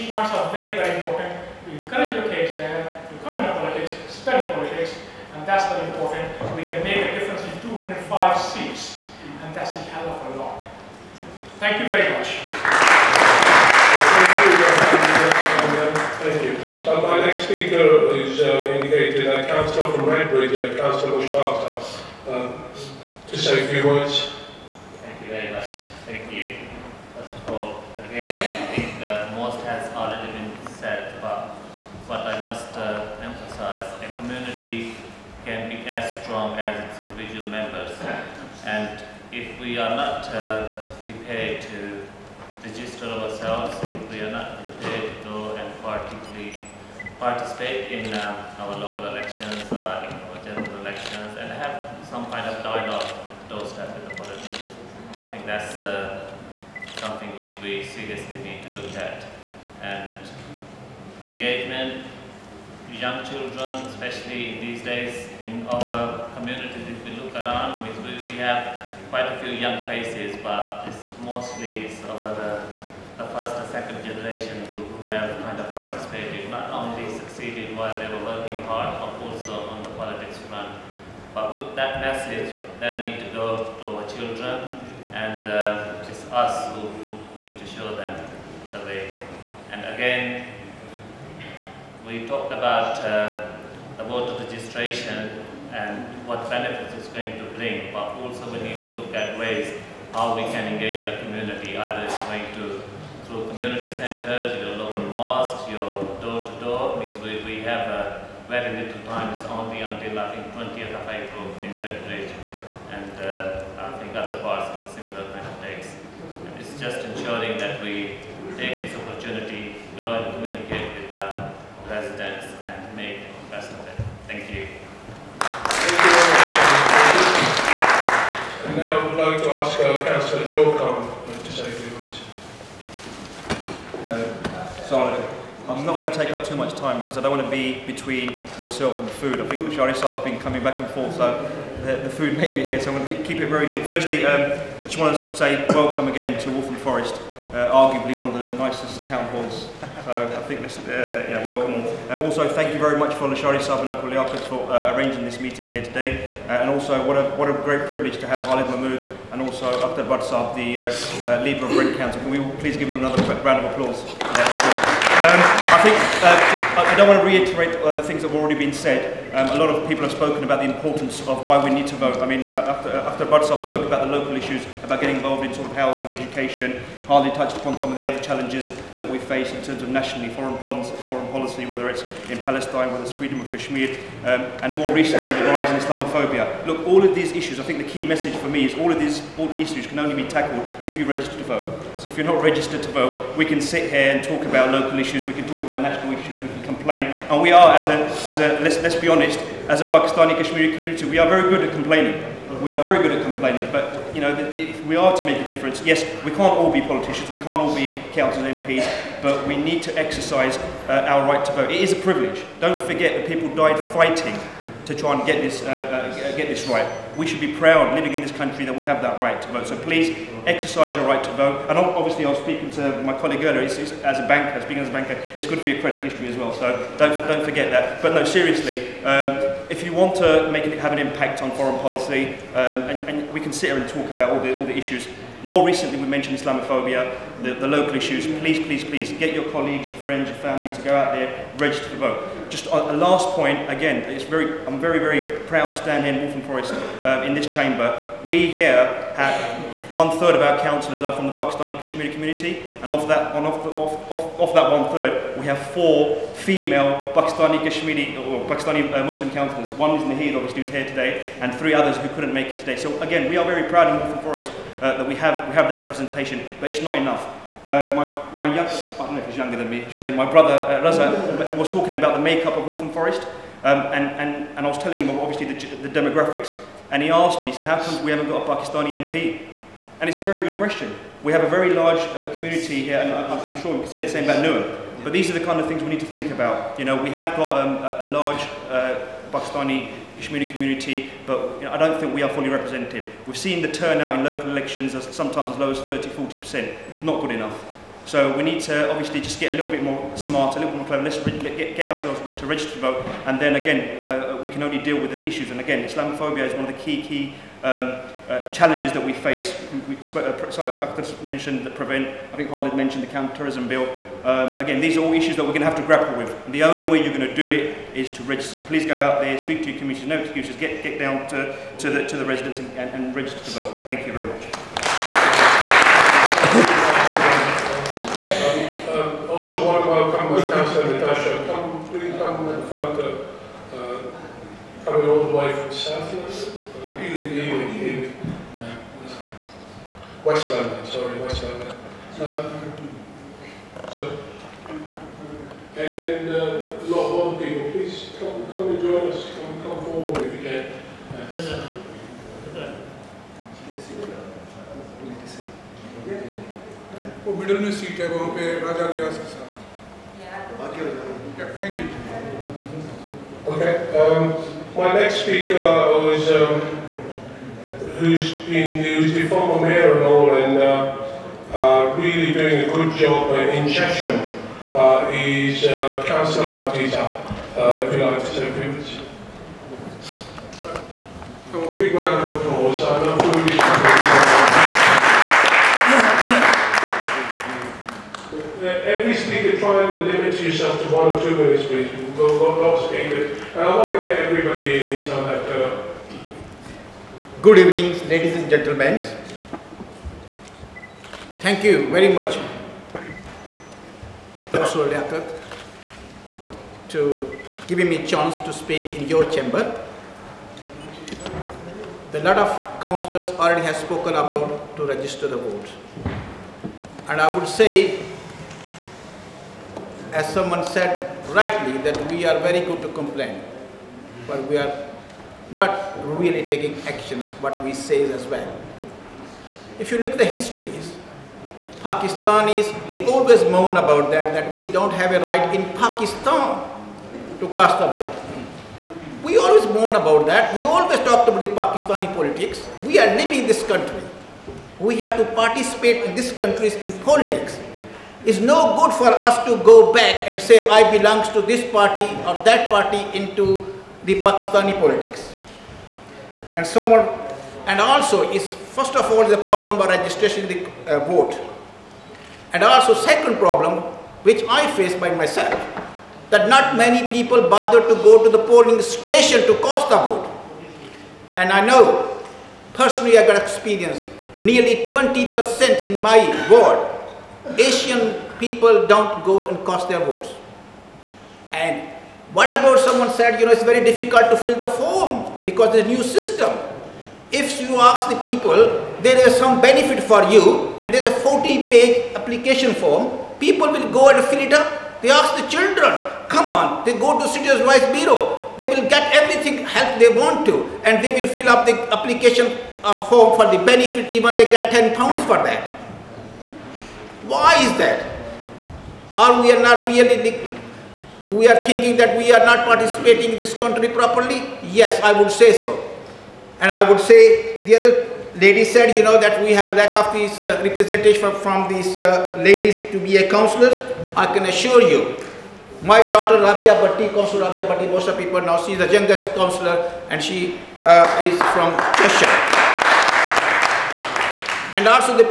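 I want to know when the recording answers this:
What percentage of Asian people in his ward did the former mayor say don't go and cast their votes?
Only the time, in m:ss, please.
7:54.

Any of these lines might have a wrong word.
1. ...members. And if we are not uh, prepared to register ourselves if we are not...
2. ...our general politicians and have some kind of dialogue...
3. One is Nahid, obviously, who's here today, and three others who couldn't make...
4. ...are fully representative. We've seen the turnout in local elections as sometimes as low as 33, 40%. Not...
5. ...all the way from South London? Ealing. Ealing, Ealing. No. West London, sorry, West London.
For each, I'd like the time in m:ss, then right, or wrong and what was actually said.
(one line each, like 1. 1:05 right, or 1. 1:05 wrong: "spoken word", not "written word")
1. 0:37 right
2. 0:50 wrong: "elections", not "politicians"
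3. 4:19 right
4. 4:52 wrong: "30", not "33"
5. 5:35 right.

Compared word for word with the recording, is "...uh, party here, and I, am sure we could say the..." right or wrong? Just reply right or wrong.
wrong.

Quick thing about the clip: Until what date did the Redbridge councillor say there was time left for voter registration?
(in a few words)
20th of April.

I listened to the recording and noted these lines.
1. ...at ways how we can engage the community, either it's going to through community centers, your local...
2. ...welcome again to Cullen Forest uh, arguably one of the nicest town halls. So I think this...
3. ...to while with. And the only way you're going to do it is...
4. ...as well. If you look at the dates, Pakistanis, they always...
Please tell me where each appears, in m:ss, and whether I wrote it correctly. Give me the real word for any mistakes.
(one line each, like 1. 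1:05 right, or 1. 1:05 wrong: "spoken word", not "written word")
1. 1:39 right
2. 2:25 wrong: "Waltham", not "Cullen"
3. 5:15 wrong: "grapple", not "while"
4. 7:08 wrong: "histories", not "dates".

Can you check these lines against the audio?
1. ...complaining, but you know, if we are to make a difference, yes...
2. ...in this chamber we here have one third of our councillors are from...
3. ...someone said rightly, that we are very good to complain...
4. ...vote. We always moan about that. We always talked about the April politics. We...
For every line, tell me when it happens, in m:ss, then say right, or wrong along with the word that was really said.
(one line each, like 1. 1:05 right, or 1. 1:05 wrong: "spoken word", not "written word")
1. 3:23 right
2. 4:07 right
3. 7:00 right
4. 7:17 wrong: "Pakistani", not "April".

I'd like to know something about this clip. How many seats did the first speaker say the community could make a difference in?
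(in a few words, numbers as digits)
205.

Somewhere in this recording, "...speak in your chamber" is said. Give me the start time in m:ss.
6:48.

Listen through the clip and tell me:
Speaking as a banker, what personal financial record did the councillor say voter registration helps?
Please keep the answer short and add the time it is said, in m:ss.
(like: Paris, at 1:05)
credit history, at 3:45.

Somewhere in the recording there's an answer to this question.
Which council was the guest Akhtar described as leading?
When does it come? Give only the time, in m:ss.
2:41.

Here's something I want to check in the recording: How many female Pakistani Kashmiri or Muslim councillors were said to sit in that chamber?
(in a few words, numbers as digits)
four.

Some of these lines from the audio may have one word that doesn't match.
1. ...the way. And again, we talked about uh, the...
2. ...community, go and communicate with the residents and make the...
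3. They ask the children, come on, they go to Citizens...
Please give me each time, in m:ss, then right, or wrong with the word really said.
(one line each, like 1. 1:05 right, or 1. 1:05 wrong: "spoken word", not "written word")
1. 1:28 right
2. 1:59 wrong: "opportunity", not "community"
3. 8:15 right.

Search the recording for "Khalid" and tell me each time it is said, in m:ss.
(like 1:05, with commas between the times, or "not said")
2:38, 5:12.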